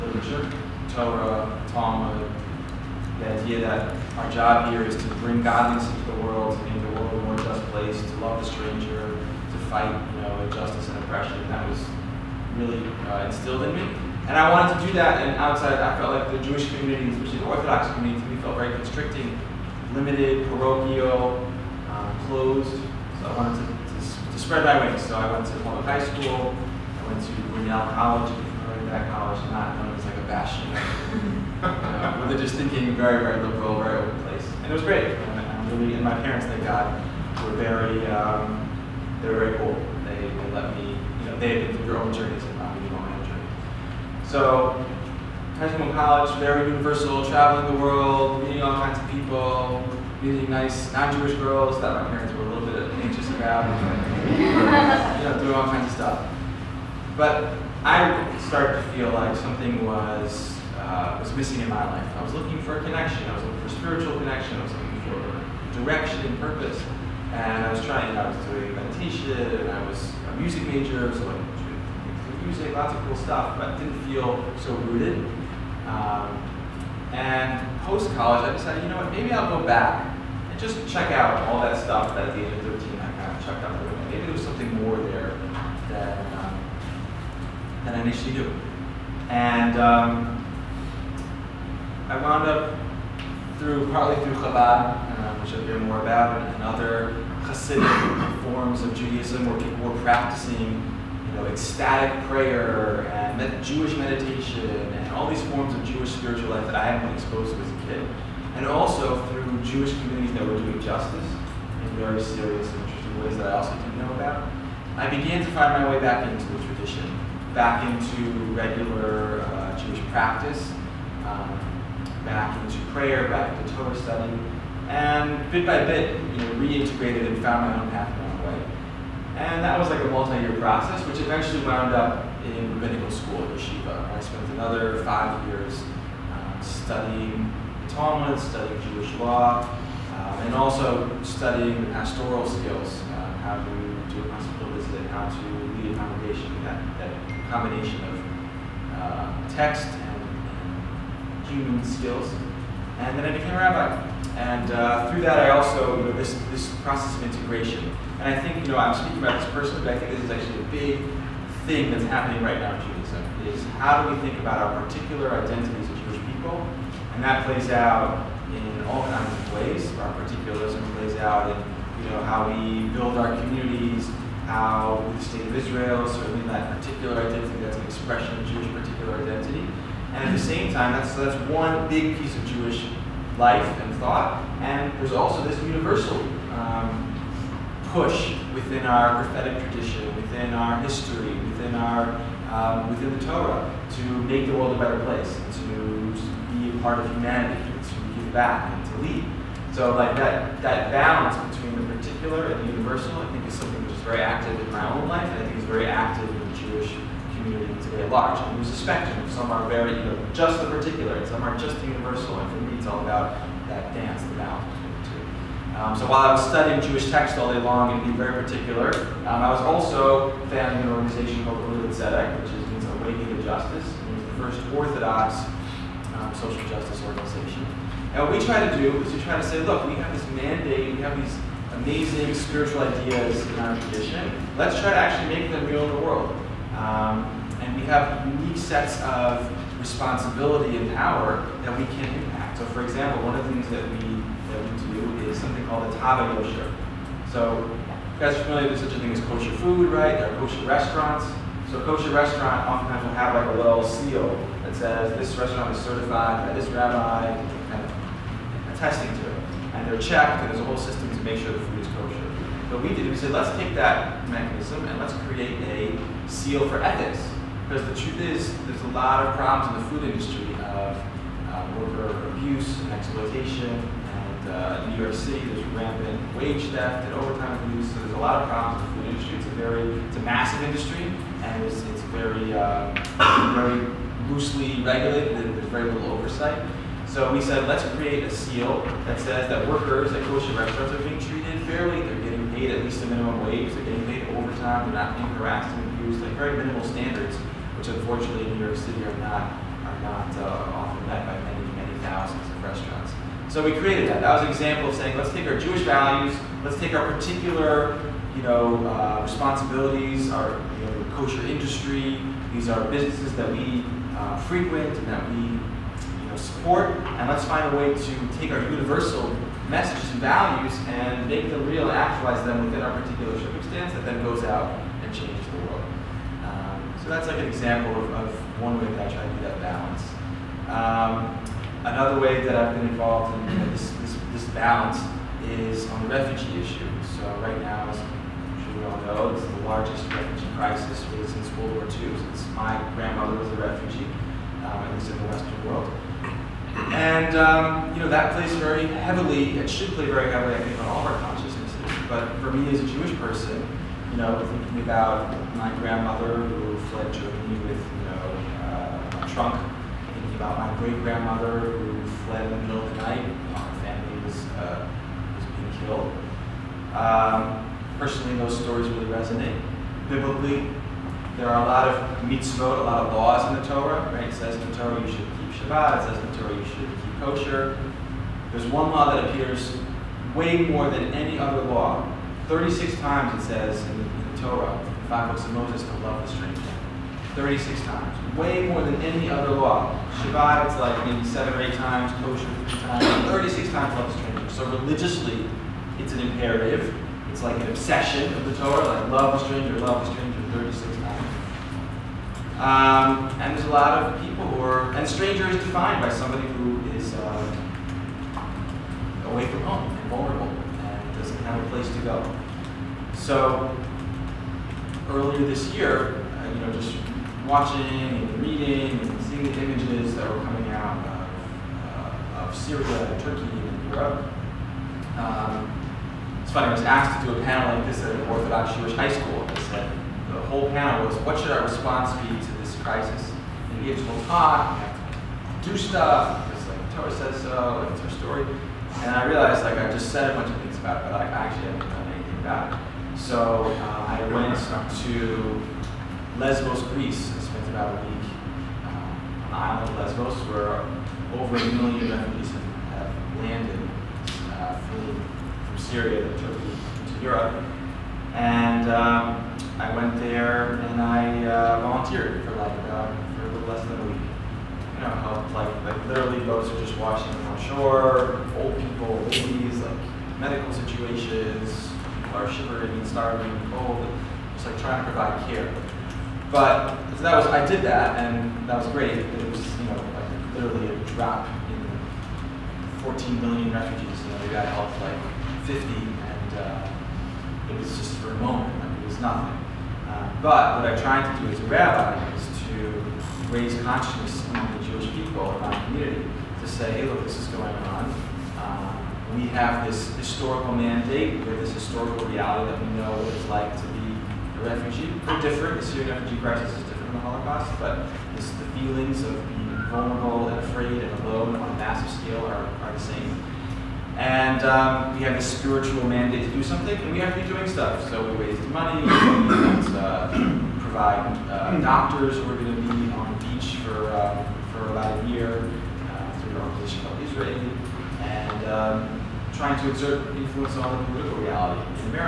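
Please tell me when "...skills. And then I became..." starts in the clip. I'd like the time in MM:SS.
02:31.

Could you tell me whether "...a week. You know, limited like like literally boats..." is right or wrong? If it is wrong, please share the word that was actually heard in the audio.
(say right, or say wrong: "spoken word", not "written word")
wrong: "helped", not "limited".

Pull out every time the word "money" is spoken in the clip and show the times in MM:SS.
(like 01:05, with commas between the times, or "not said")
08:38.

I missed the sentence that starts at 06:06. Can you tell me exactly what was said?
Um, personally, those stories really resonate.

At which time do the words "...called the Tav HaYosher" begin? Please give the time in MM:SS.
04:05.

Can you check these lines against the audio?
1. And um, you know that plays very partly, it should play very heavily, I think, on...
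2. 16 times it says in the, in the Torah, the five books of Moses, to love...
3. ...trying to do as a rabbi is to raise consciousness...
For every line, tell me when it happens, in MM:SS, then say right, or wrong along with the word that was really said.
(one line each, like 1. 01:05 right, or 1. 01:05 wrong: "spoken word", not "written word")
1. 05:46 wrong: "heavily", not "partly"
2. 06:22 wrong: "36", not "16"
3. 08:10 right.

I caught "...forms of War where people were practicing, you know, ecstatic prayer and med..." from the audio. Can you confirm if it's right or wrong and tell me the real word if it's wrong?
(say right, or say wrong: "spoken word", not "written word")
wrong: "Judaism", not "War".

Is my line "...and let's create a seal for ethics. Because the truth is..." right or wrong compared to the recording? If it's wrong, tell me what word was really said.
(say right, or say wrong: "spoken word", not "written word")
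right.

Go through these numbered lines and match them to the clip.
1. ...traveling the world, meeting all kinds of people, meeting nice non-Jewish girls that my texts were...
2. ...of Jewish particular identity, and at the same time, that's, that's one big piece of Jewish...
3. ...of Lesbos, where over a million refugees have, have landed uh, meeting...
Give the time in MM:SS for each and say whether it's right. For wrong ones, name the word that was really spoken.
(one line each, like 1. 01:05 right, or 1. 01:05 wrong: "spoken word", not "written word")
1. 00:47 wrong: "parents", not "texts"
2. 02:58 right
3. 07:29 wrong: "fleeing", not "meeting".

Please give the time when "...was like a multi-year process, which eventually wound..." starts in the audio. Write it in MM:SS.
02:09.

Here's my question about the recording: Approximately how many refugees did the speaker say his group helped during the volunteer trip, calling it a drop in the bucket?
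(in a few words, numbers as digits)
50.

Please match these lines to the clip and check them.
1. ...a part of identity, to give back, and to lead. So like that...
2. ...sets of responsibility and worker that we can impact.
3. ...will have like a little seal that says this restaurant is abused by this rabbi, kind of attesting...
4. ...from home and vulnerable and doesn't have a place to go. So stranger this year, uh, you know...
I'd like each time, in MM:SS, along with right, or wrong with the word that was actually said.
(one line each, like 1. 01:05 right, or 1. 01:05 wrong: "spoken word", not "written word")
1. 03:16 wrong: "humanity", not "identity"
2. 03:58 wrong: "power", not "worker"
3. 04:13 wrong: "certified", not "abused"
4. 06:49 wrong: "earlier", not "stranger".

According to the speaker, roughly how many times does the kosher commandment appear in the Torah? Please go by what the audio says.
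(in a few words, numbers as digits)
3.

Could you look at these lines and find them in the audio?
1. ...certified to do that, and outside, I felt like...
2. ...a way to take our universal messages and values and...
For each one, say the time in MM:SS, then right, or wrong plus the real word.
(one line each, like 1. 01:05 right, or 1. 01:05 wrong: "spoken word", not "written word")
1. 00:14 wrong: "wanted", not "certified"
2. 05:17 right.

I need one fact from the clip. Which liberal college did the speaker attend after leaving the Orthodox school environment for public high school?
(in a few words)
Grinnell College.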